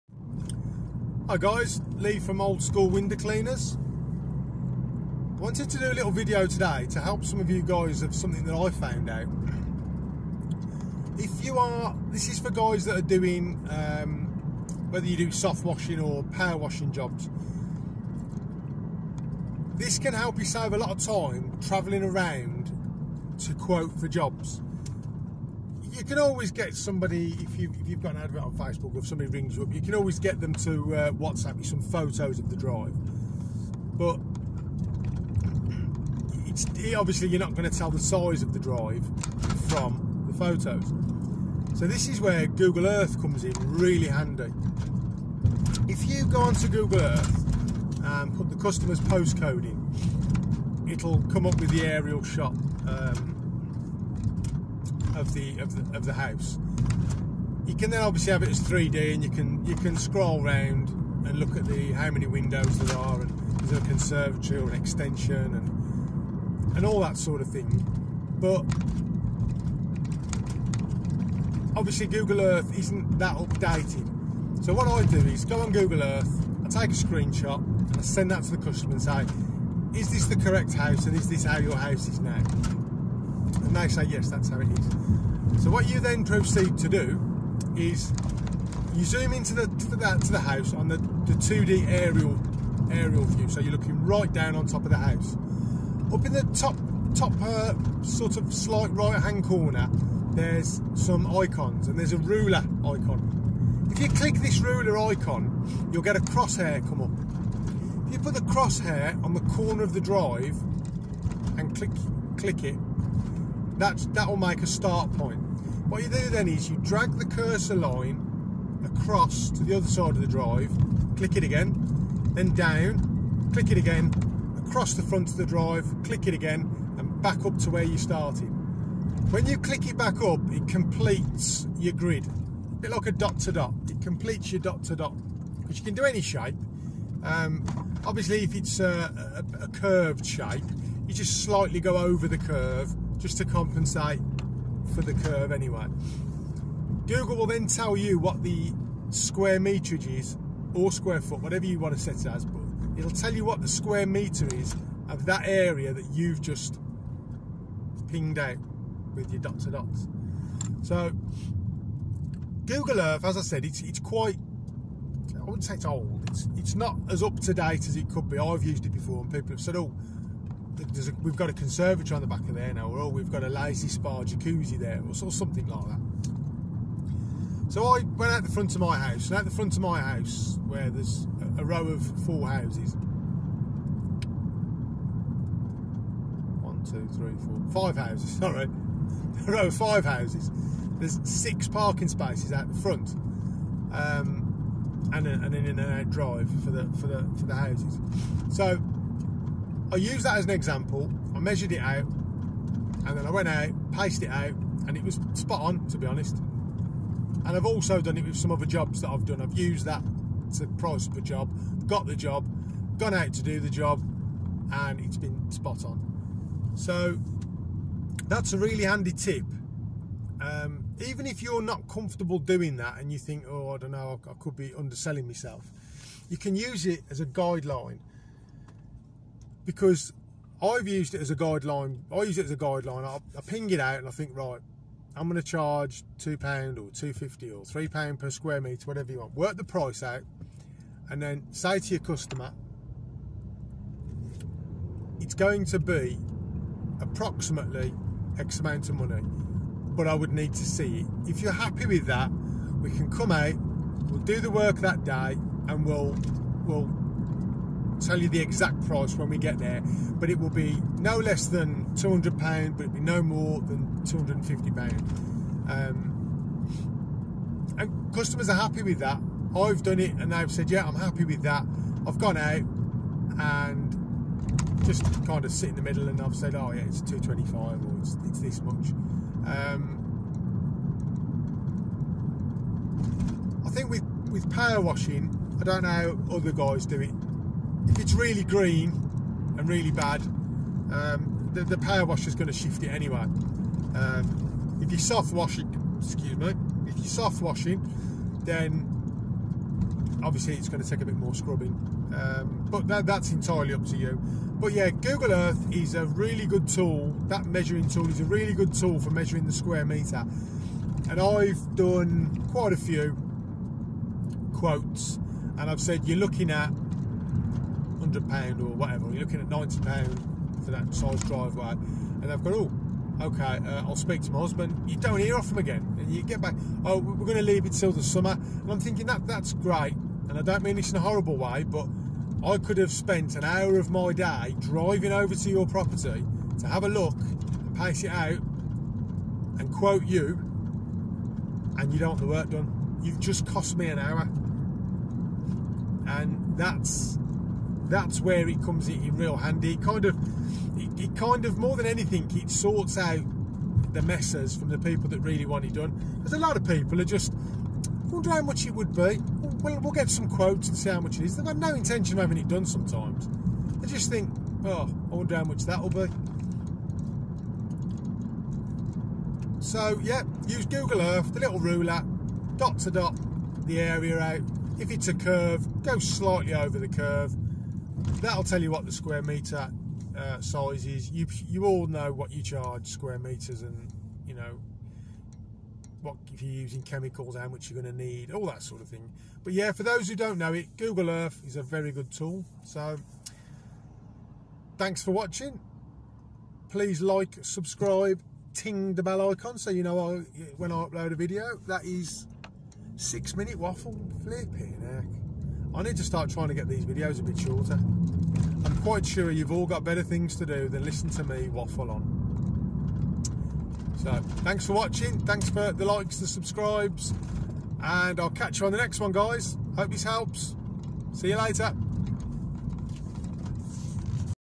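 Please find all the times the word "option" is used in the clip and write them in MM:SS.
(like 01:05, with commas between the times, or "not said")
not said.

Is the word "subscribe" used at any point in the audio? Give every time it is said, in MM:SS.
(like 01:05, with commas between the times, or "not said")
06:37, 06:56.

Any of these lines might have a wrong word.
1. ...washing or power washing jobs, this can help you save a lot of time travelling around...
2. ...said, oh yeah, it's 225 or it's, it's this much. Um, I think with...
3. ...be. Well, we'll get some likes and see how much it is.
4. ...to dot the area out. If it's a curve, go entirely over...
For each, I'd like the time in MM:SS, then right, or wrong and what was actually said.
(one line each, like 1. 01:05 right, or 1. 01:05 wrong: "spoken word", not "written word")
1. 00:15 right
2. 04:36 right
3. 05:58 wrong: "quotes", not "likes"
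4. 06:12 wrong: "slightly", not "entirely".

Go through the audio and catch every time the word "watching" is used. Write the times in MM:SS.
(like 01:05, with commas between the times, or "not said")
06:35, 06:54.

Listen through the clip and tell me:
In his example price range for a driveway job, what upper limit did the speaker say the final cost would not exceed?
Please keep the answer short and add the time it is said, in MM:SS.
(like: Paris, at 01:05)
£250, at 04:24.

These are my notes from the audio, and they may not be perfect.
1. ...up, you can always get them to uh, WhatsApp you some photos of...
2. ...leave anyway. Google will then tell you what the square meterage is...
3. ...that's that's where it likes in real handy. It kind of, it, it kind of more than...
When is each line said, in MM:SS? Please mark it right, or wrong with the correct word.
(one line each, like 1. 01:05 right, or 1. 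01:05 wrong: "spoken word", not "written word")
1. 00:29 right
2. 02:25 wrong: "curve", not "leave"
3. 05:46 wrong: "comes", not "likes".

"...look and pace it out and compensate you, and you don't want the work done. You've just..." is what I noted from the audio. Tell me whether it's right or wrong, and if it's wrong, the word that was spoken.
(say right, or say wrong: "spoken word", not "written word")
wrong: "quote", not "compensate".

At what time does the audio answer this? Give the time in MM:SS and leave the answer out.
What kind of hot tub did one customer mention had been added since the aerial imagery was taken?
02:53.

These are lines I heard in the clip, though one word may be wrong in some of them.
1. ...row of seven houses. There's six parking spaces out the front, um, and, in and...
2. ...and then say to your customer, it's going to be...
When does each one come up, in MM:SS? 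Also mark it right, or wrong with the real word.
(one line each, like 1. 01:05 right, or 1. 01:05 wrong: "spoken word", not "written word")
1. 03:09 wrong: "five", not "seven"
2. 04:01 right.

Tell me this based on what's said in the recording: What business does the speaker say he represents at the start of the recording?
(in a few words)
Old School Window Cleaners.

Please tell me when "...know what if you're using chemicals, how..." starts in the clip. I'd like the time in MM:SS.
06:24.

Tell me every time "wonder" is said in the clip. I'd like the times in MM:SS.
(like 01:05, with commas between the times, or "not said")
05:58, 06:05.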